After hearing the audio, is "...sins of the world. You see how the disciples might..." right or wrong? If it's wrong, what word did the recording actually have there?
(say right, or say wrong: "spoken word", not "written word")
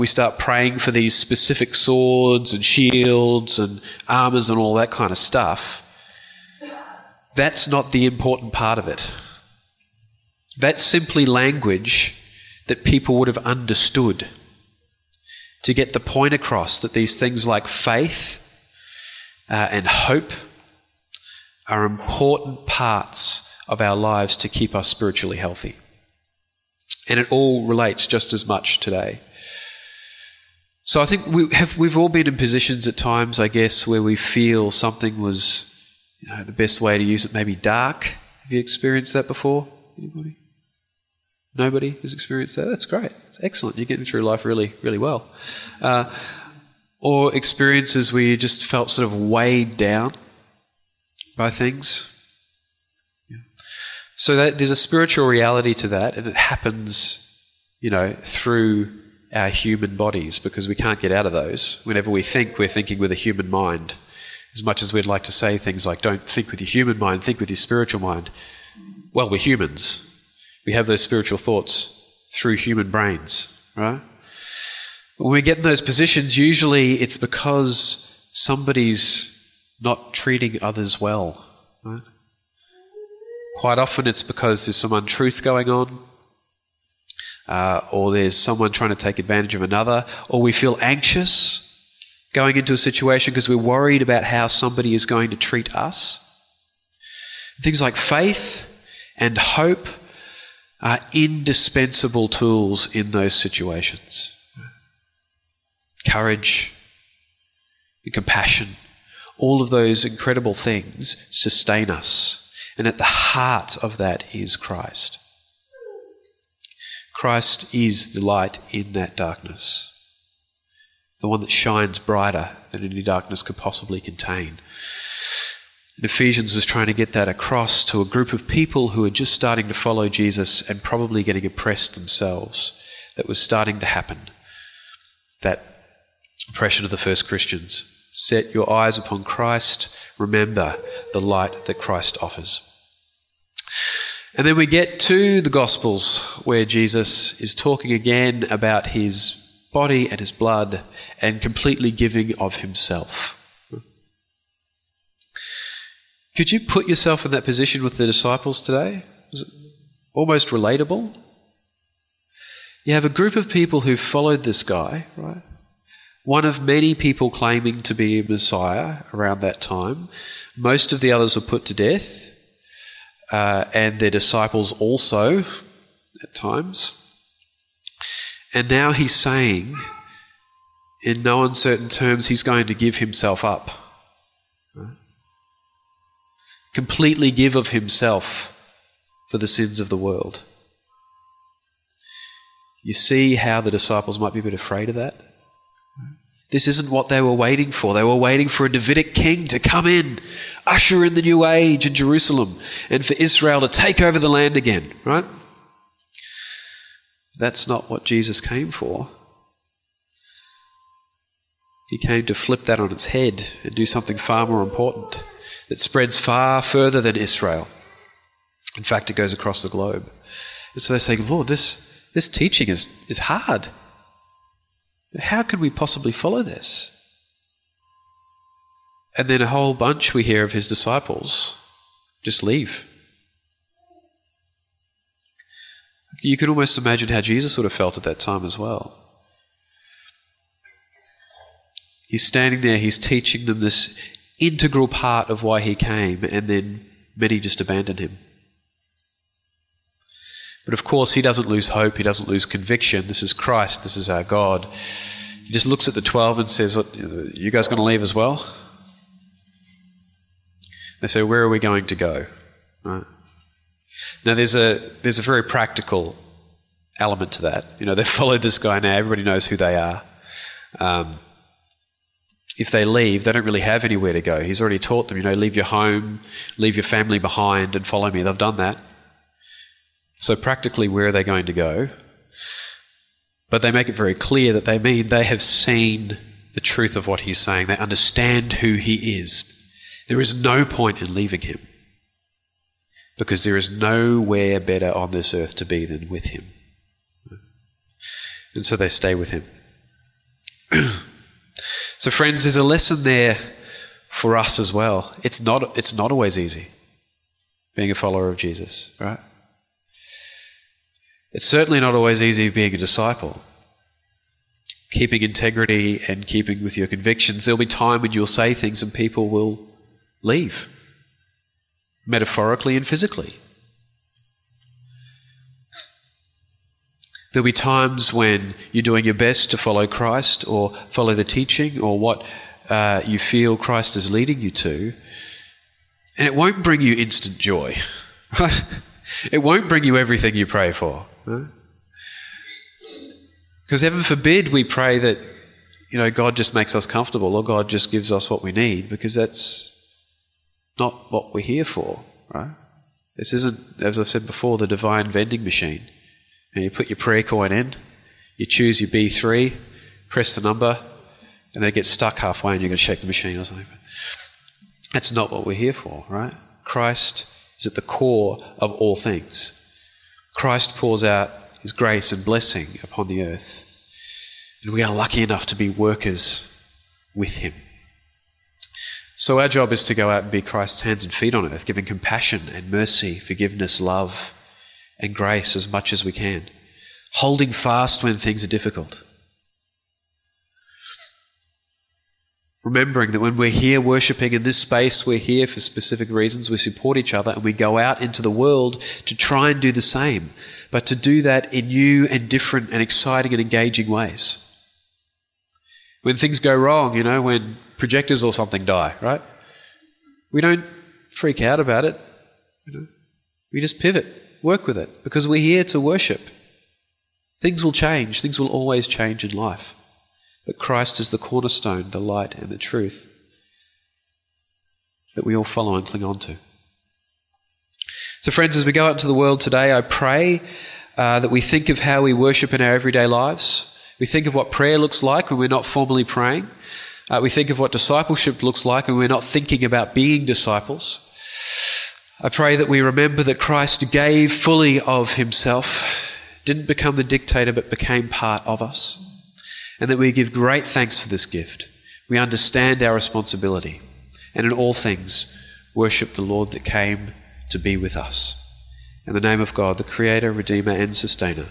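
right.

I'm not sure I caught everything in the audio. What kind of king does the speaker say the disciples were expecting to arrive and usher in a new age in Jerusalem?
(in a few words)
Davidic king.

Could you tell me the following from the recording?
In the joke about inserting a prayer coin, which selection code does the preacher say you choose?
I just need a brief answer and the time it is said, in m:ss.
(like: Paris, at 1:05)
B3, at 5:58.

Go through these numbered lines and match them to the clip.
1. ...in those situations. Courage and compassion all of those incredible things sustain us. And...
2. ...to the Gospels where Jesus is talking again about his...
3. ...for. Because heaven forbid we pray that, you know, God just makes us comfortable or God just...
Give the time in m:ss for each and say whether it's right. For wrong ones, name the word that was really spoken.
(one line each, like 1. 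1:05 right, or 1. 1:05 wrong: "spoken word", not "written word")
1. 1:42 right
2. 2:24 right
3. 5:40 right.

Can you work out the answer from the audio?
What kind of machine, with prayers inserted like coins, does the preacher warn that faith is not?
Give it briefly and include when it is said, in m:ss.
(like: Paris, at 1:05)
divine vending machine, at 5:54.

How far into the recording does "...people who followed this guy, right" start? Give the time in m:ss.
2:43.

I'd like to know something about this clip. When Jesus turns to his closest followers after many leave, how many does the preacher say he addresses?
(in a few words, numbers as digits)
12.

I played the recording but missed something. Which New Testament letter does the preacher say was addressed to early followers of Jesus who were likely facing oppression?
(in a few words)
Ephesians.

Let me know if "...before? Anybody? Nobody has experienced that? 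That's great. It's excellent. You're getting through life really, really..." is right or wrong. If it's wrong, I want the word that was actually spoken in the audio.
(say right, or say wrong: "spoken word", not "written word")
right.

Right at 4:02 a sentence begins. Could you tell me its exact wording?
He's standing there, he's teaching them this integral part of why he came, and then many just abandon him.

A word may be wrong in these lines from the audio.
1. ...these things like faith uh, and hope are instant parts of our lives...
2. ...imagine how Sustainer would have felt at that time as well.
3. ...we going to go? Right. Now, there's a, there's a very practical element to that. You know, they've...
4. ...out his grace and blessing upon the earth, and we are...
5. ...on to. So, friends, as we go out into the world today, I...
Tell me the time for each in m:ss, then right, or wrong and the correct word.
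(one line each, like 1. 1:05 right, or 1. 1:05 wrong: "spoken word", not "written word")
1. 0:16 wrong: "important", not "instant"
2. 3:56 wrong: "Jesus", not "Sustainer"
3. 4:21 right
4. 6:11 right
5. 7:06 right.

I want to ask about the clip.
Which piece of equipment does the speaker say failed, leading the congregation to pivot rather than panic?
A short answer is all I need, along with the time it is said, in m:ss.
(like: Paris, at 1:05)
Projectors, at 6:47.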